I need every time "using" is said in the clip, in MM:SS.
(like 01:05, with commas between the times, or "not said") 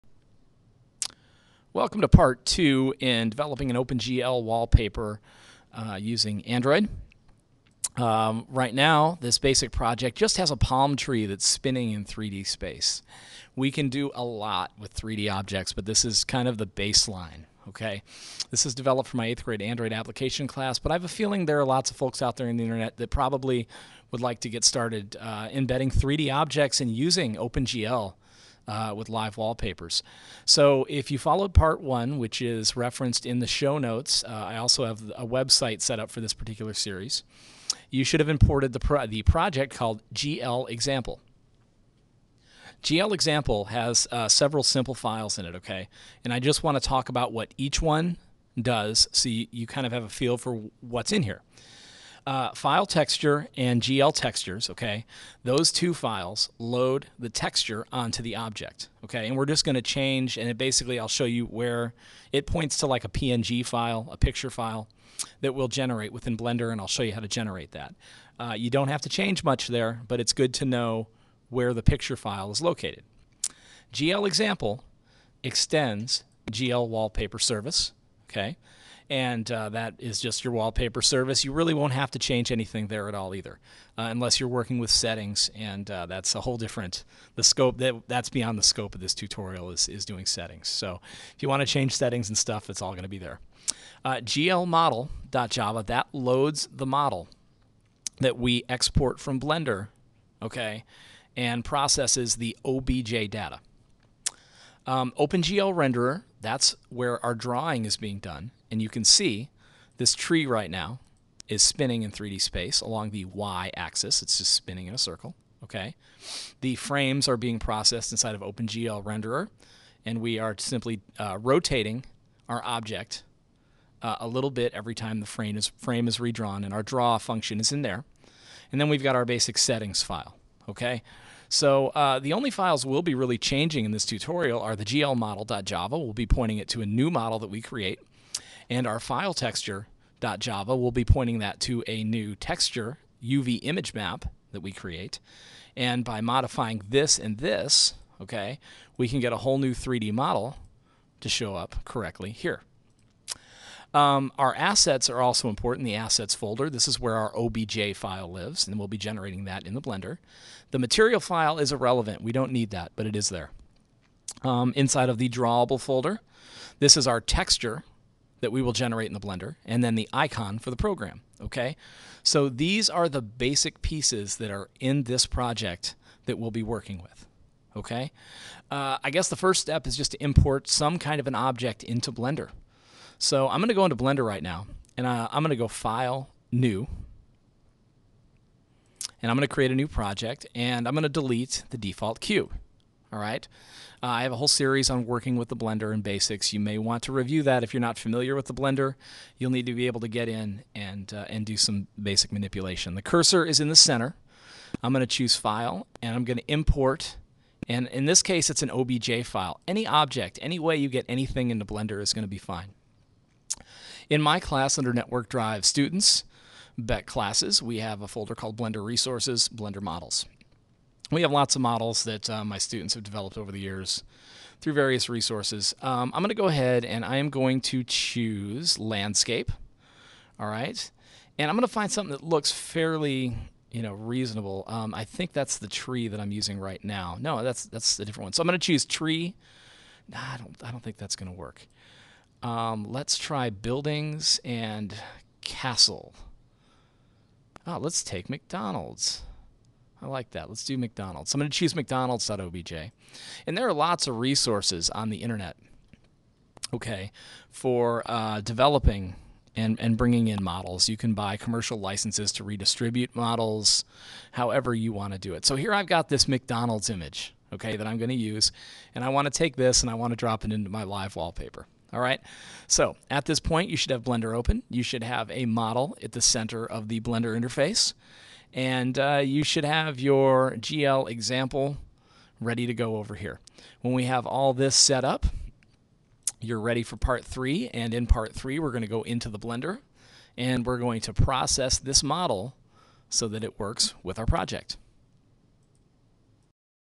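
00:06, 00:26, 03:56.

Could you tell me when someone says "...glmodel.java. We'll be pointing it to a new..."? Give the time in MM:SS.
02:14.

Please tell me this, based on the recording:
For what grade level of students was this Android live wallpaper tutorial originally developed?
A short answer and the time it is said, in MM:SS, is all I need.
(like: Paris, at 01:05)
8th grade, at 00:19.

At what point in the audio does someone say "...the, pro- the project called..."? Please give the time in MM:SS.
00:38.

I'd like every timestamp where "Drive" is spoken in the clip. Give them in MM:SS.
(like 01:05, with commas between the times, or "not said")
03:35.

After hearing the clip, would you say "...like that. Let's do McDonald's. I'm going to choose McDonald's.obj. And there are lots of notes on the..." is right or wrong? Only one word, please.
wrong.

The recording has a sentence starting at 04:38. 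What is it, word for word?
And uh, you should have your GL example ready to go over here.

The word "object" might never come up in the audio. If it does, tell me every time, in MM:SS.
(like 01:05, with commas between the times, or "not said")
00:15, 00:26, 00:58, 02:02, 03:01, 03:29.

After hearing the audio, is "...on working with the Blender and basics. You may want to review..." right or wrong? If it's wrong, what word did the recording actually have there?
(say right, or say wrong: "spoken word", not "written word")
right.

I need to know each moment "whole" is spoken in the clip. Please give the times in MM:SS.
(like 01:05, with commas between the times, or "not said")
01:26, 02:29, 03:14.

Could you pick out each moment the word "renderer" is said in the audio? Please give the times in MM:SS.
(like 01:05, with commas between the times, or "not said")
01:45, 01:59.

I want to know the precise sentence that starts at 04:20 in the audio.
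You can buy commercial licenses to redistribute models, however you want to do it.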